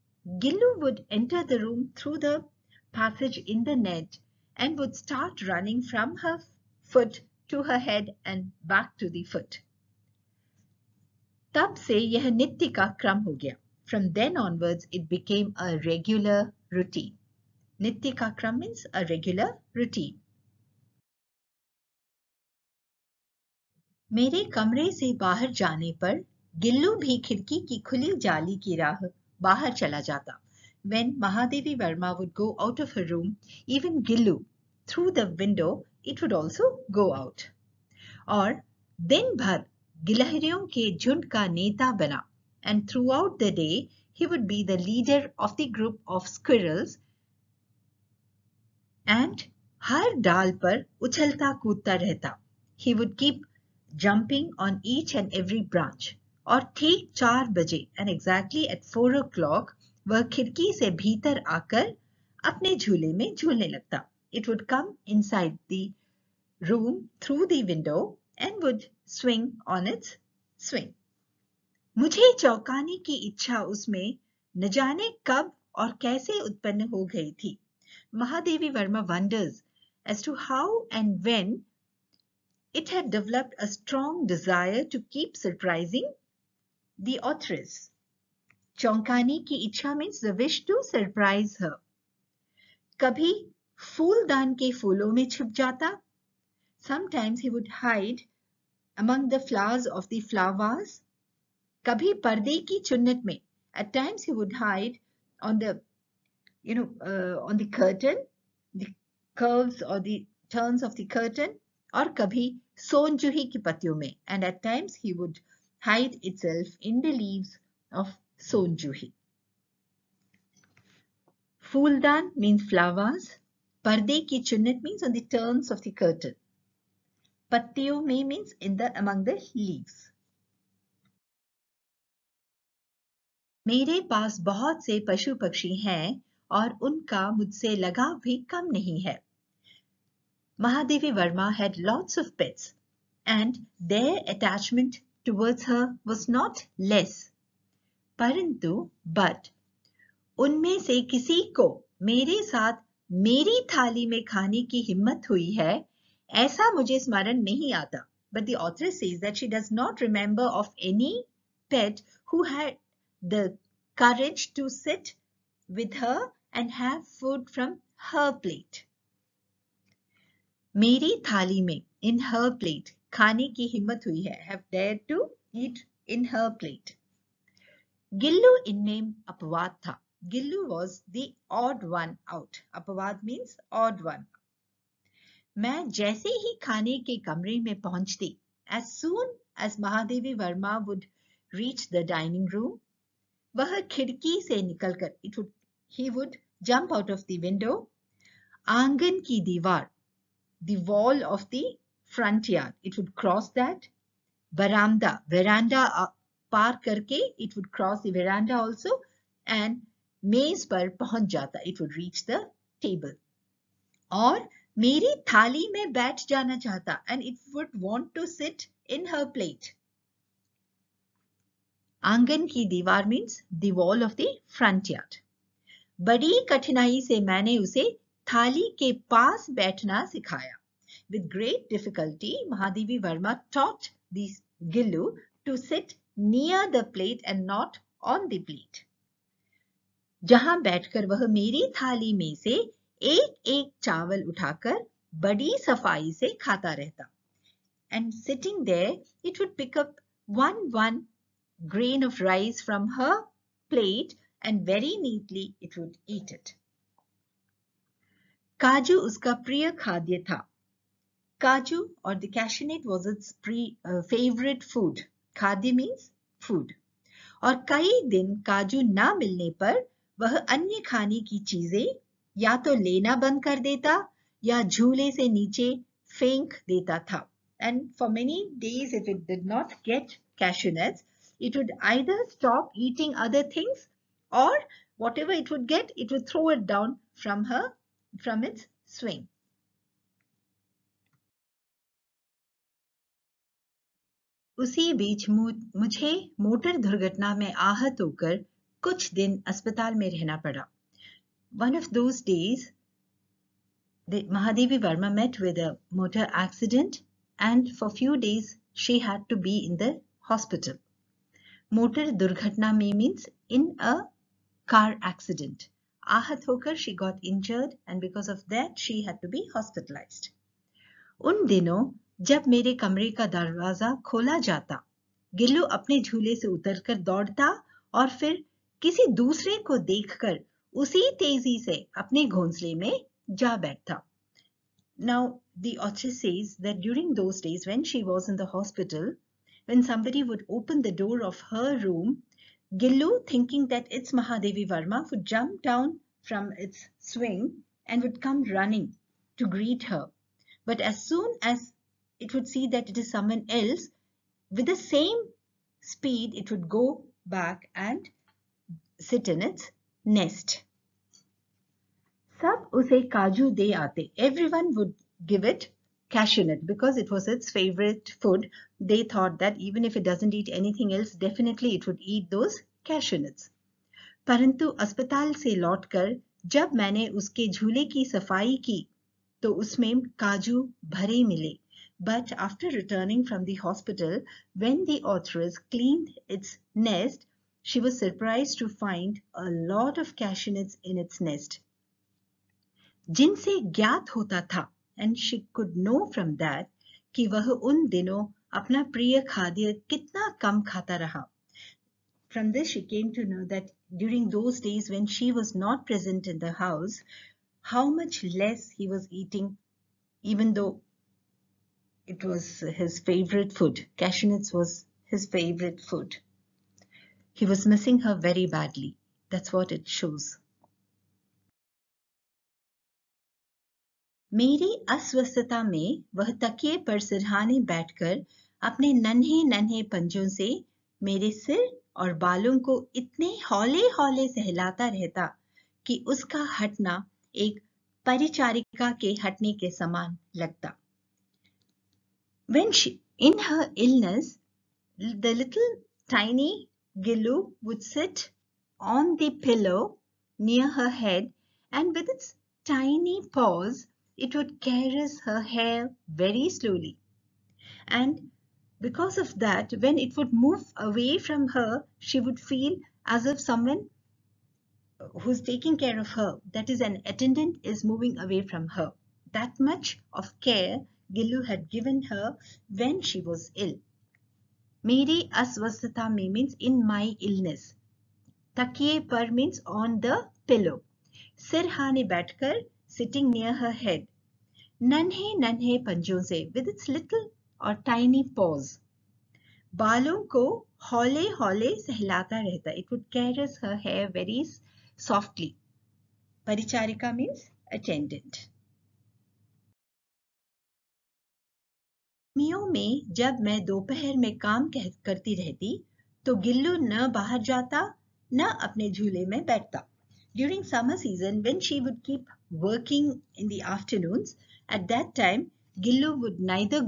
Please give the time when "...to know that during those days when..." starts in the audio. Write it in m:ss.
6:43.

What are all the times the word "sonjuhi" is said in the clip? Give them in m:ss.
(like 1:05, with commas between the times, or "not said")
1:52, 1:58.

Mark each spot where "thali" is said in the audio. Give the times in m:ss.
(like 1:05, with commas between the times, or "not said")
4:01.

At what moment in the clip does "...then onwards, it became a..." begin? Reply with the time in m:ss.
0:14.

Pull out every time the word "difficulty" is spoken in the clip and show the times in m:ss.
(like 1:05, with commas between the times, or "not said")
3:51.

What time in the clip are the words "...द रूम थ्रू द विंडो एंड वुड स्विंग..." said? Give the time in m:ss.
1:05.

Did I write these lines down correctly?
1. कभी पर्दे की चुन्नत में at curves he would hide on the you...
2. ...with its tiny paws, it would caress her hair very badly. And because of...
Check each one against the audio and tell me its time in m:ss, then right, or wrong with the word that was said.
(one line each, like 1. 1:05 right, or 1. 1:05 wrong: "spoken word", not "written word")
1. 1:41 wrong: "times", not "curves"
2. 7:31 wrong: "slowly", not "badly".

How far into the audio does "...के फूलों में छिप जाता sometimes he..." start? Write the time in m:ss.
1:34.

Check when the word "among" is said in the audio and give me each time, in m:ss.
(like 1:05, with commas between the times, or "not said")
1:38, 2:09.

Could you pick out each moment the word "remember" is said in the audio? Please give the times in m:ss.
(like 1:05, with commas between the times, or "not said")
2:40.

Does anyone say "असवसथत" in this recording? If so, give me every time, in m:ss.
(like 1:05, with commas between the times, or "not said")
7:04, 7:55.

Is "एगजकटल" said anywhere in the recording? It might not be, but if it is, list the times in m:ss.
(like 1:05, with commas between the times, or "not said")
0:58.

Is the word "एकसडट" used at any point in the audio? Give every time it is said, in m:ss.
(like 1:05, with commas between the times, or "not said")
5:06, 5:15.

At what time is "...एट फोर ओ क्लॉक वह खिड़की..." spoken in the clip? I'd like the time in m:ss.
0:58.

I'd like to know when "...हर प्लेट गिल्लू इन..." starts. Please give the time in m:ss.
2:56.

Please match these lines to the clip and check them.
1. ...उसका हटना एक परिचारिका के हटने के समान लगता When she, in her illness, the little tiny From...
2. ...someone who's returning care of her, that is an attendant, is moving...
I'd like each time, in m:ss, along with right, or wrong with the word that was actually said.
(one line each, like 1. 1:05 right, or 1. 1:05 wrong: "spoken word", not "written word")
1. 7:16 wrong: "Gillu", not "From"
2. 7:43 wrong: "taking", not "returning".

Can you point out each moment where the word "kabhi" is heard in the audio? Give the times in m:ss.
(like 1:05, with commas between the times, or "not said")
1:52.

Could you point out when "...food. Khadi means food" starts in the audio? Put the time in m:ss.
4:24.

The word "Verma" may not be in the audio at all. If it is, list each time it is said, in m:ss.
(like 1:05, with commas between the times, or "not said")
2:21, 3:52.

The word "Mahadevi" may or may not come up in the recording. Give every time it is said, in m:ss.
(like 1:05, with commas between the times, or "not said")
2:20, 3:52.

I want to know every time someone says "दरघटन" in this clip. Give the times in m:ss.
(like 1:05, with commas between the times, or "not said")
4:56, 5:12.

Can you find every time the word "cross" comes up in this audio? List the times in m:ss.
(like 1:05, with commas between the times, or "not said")
3:23, 3:27.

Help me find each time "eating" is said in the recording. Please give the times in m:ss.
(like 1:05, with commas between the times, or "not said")
4:42, 6:49.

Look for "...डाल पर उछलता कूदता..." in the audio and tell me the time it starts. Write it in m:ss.
0:50.